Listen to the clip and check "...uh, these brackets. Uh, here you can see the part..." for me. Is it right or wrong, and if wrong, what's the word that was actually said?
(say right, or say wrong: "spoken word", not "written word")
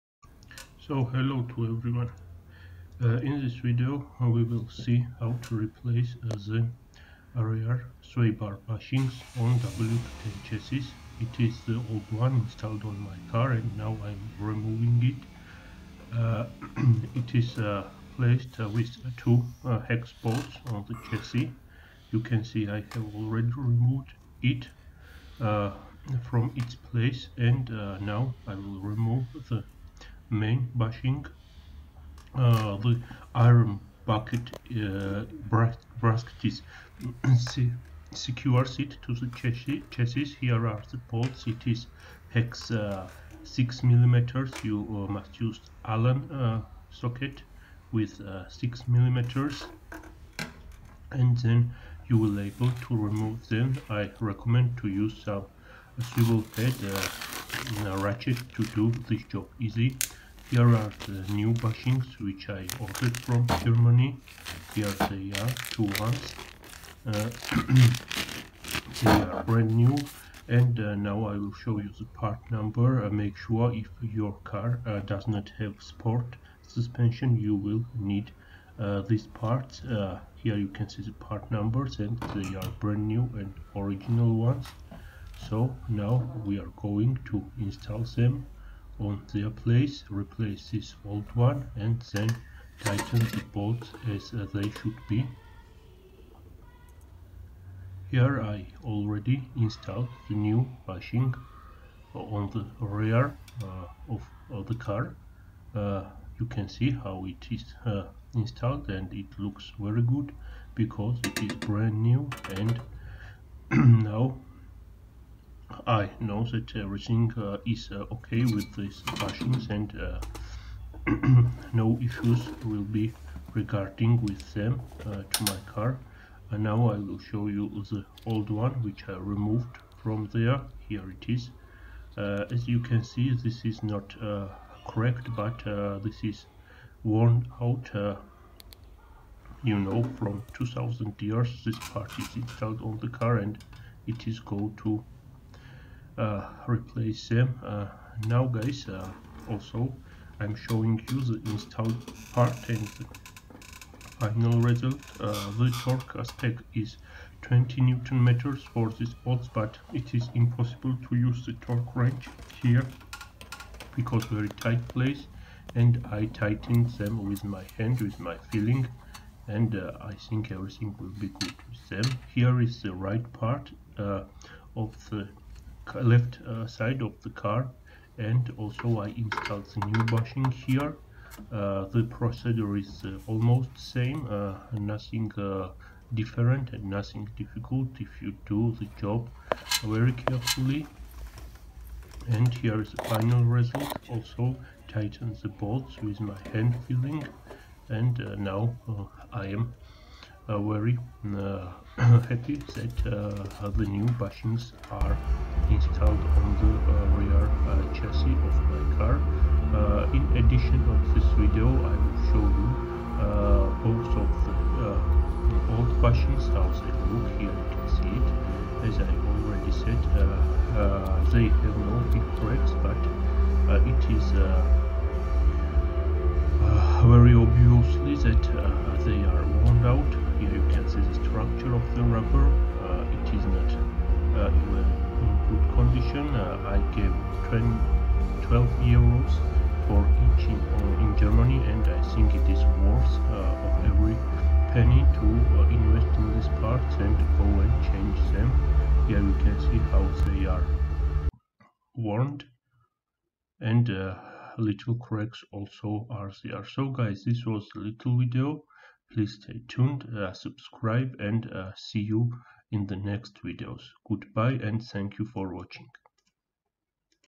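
wrong: "parts", not "brackets".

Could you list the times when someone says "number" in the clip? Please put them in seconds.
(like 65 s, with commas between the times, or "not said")
72 s, 81 s.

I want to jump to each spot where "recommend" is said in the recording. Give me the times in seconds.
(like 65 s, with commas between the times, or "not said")
54 s.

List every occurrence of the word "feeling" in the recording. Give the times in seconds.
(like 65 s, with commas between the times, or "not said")
168 s, 196 s.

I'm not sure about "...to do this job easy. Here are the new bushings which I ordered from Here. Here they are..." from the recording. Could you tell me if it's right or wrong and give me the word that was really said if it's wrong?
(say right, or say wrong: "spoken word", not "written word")
wrong: "Germany", not "Here".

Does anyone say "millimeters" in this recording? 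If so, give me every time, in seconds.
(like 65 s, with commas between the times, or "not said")
43 s, 48 s.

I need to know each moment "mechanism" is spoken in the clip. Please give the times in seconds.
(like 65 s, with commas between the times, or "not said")
not said.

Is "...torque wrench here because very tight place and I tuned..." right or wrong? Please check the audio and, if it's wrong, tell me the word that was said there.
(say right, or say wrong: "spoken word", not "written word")
wrong: "tightened", not "tuned".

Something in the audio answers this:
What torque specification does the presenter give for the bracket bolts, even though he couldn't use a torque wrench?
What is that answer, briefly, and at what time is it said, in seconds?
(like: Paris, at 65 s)
20 newton meters, at 157 s.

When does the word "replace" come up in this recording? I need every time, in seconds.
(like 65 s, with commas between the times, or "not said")
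5 s, 90 s, 146 s.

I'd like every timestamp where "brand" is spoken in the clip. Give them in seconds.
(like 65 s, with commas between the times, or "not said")
69 s, 82 s, 111 s.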